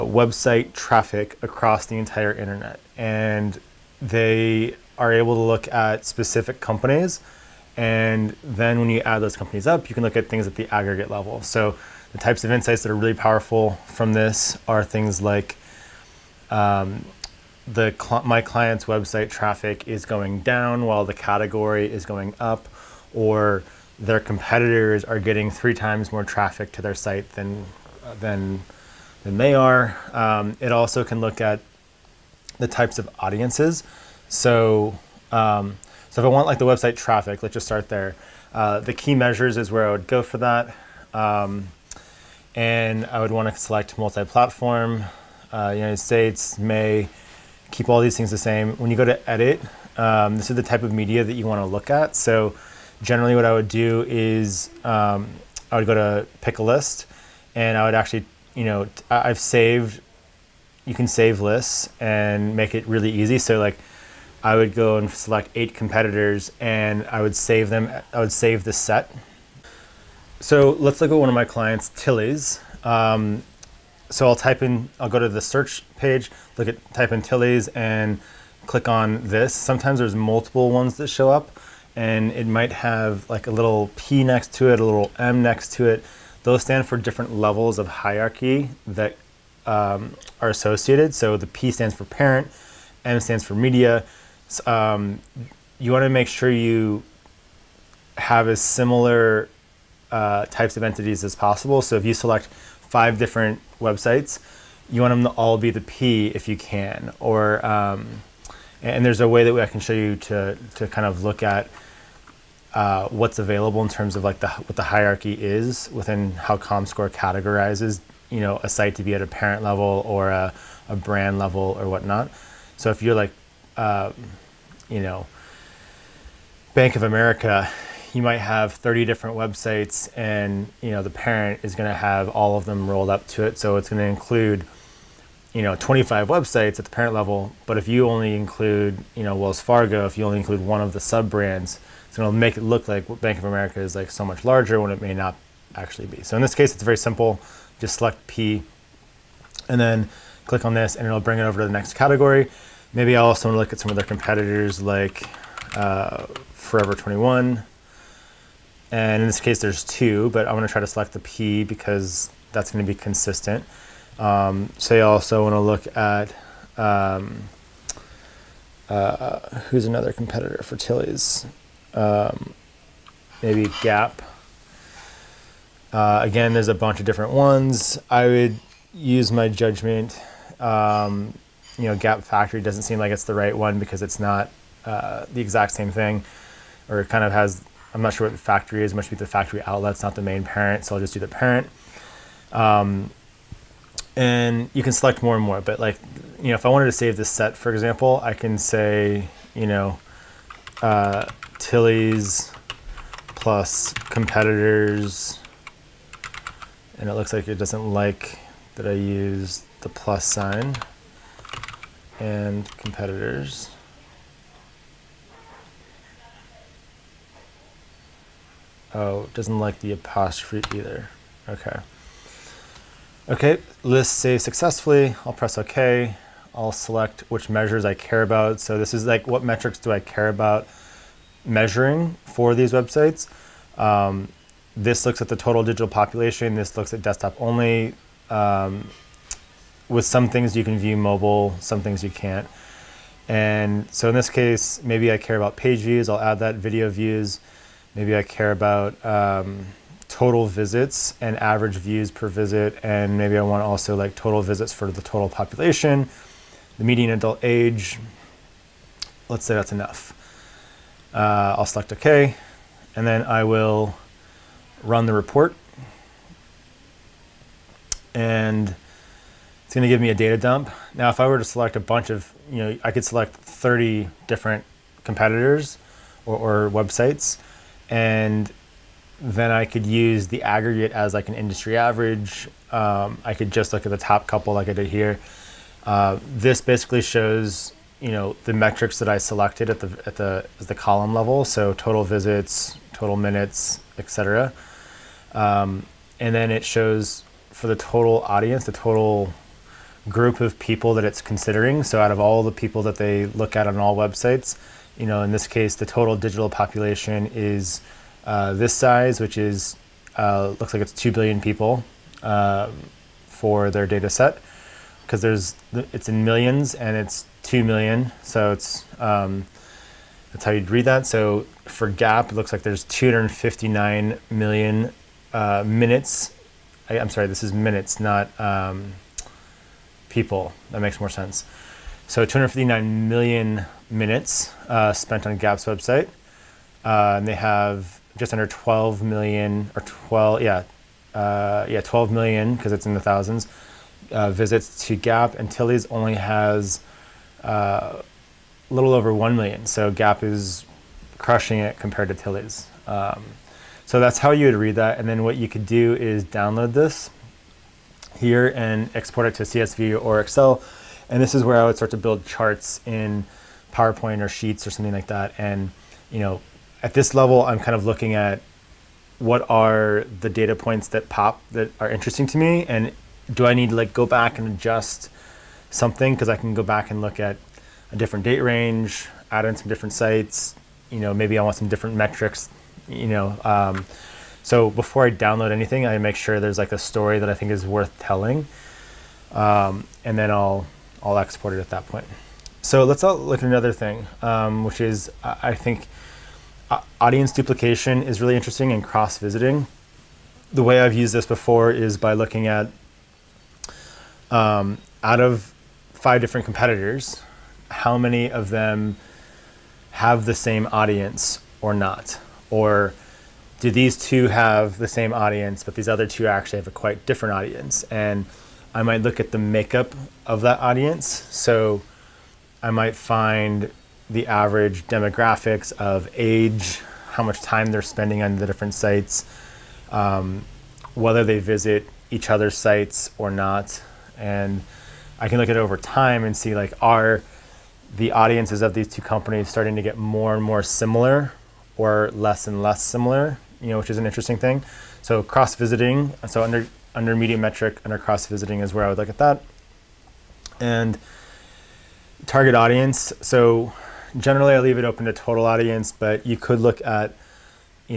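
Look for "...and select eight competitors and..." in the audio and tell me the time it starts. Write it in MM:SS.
01:04.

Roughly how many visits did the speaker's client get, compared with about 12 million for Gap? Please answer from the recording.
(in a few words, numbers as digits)
a little over 1 million.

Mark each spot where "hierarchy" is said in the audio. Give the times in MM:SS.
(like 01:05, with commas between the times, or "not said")
01:27, 01:54.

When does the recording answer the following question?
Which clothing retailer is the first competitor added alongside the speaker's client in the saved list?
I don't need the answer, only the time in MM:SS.
02:36.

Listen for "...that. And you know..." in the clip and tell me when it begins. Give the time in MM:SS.
06:05.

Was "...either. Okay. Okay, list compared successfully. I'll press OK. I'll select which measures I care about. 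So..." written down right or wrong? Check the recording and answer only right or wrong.
wrong.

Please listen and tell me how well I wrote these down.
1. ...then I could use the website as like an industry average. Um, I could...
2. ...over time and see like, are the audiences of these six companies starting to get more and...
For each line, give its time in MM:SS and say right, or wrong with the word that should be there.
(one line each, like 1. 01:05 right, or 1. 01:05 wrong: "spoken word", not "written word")
1. 04:39 wrong: "aggregate", not "website"
2. 07:15 wrong: "two", not "six".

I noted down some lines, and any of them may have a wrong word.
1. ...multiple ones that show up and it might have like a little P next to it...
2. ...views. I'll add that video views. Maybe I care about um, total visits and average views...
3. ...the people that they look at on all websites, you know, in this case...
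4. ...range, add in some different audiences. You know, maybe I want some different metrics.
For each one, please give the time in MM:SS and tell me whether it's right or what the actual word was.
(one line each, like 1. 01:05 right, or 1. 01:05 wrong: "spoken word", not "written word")
1. 01:20 right
2. 04:05 right
3. 05:02 right
4. 06:18 wrong: "sites", not "audiences".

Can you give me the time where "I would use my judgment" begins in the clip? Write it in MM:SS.
02:58.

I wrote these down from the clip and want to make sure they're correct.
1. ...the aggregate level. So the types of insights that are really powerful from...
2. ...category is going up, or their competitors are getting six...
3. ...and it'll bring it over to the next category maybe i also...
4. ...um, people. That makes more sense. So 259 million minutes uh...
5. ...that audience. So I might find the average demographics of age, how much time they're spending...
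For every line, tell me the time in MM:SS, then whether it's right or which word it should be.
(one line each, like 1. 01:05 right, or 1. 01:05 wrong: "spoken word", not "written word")
1. 00:10 right
2. 00:21 wrong: "three", not "six"
3. 02:30 right
4. 05:28 right
5. 07:00 right.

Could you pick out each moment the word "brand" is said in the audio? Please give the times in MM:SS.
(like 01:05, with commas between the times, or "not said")
02:00, 02:21.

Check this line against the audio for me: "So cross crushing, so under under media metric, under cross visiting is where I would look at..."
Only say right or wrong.
wrong.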